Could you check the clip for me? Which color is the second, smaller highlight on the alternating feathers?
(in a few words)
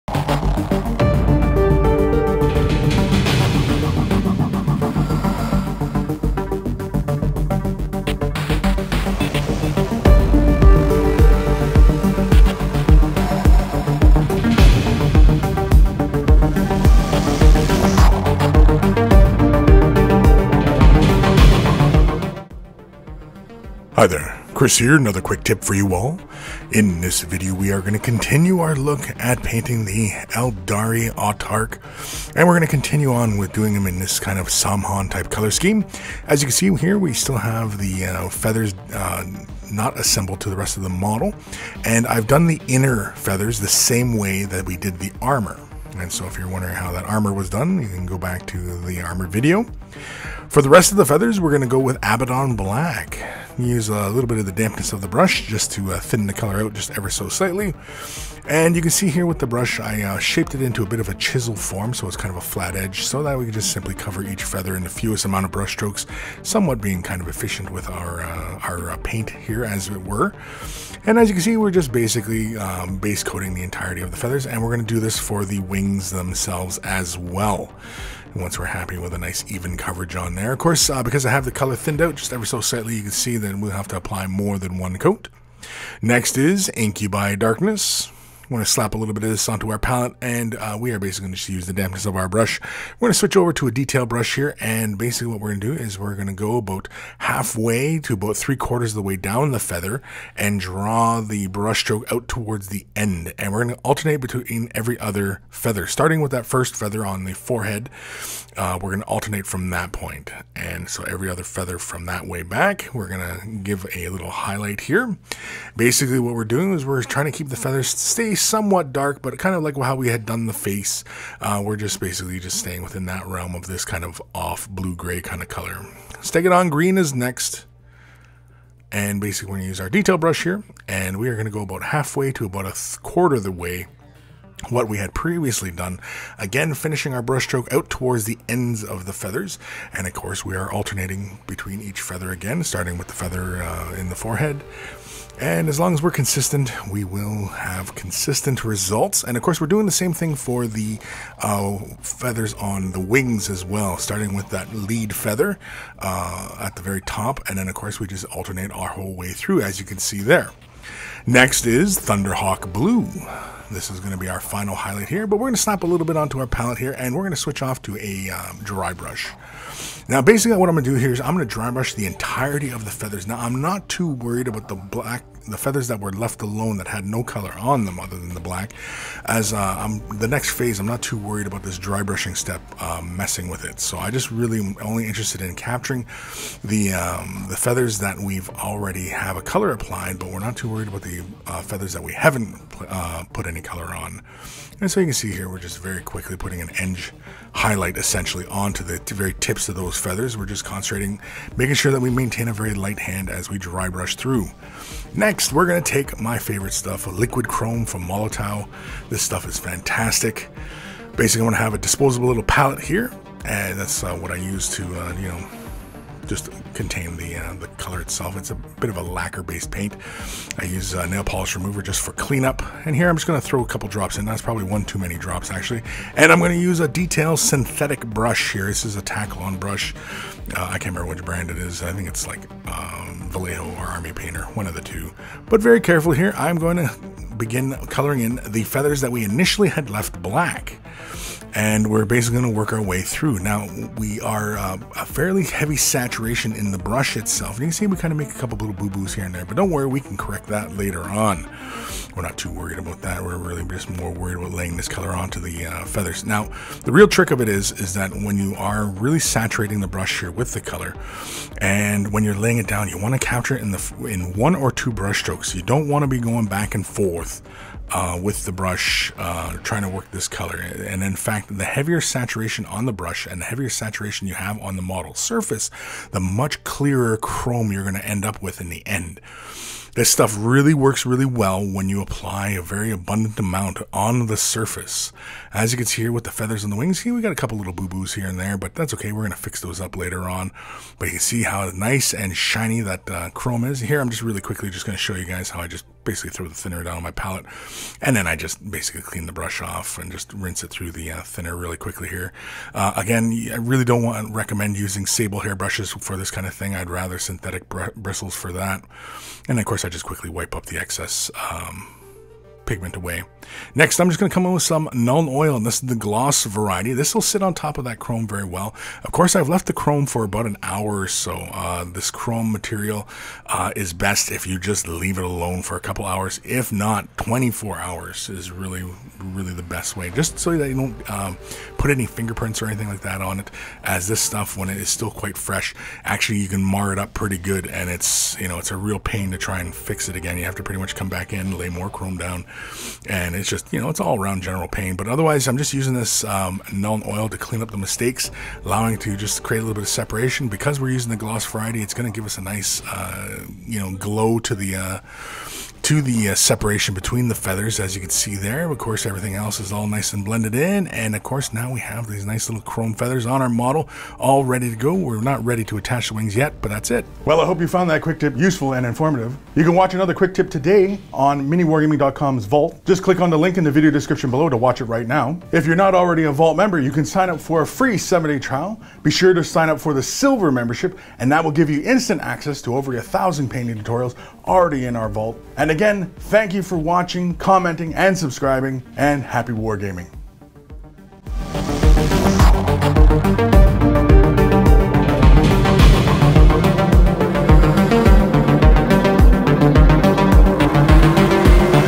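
Stegadon green.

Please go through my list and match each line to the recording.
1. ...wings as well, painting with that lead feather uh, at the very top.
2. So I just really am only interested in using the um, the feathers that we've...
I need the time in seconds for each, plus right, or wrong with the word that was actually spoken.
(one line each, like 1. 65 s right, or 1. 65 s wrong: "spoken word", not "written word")
1. 152 s wrong: "starting", not "painting"
2. 183 s wrong: "capturing", not "using".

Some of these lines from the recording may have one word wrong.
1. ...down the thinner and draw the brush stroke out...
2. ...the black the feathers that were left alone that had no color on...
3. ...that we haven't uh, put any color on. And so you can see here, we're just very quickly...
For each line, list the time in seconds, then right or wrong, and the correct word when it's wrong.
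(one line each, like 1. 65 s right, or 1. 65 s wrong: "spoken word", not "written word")
1. 99 s wrong: "feather", not "thinner"
2. 174 s right
3. 191 s right.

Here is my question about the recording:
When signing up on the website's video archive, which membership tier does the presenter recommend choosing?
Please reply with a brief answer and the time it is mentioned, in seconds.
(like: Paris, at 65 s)
Silver, at 380 s.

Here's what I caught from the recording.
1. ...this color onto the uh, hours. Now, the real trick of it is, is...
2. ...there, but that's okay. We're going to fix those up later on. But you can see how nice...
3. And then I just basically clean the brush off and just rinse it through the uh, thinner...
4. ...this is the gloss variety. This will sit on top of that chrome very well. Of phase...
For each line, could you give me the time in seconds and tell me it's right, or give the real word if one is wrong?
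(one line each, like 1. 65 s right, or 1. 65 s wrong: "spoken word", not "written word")
1. 254 s wrong: "feathers", not "hours"
2. 288 s right
3. 298 s right
4. 315 s wrong: "course", not "phase".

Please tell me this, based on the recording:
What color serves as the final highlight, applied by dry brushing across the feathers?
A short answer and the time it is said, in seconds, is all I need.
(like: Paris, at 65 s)
Thunderhawk Blue, at 161 s.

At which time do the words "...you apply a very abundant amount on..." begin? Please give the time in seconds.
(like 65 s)
281 s.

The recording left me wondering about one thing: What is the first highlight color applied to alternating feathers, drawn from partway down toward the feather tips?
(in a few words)
Incubi Darkness.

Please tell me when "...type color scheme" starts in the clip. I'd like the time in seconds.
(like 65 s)
35 s.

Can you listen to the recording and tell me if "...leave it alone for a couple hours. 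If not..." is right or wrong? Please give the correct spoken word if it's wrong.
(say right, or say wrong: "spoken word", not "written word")
right.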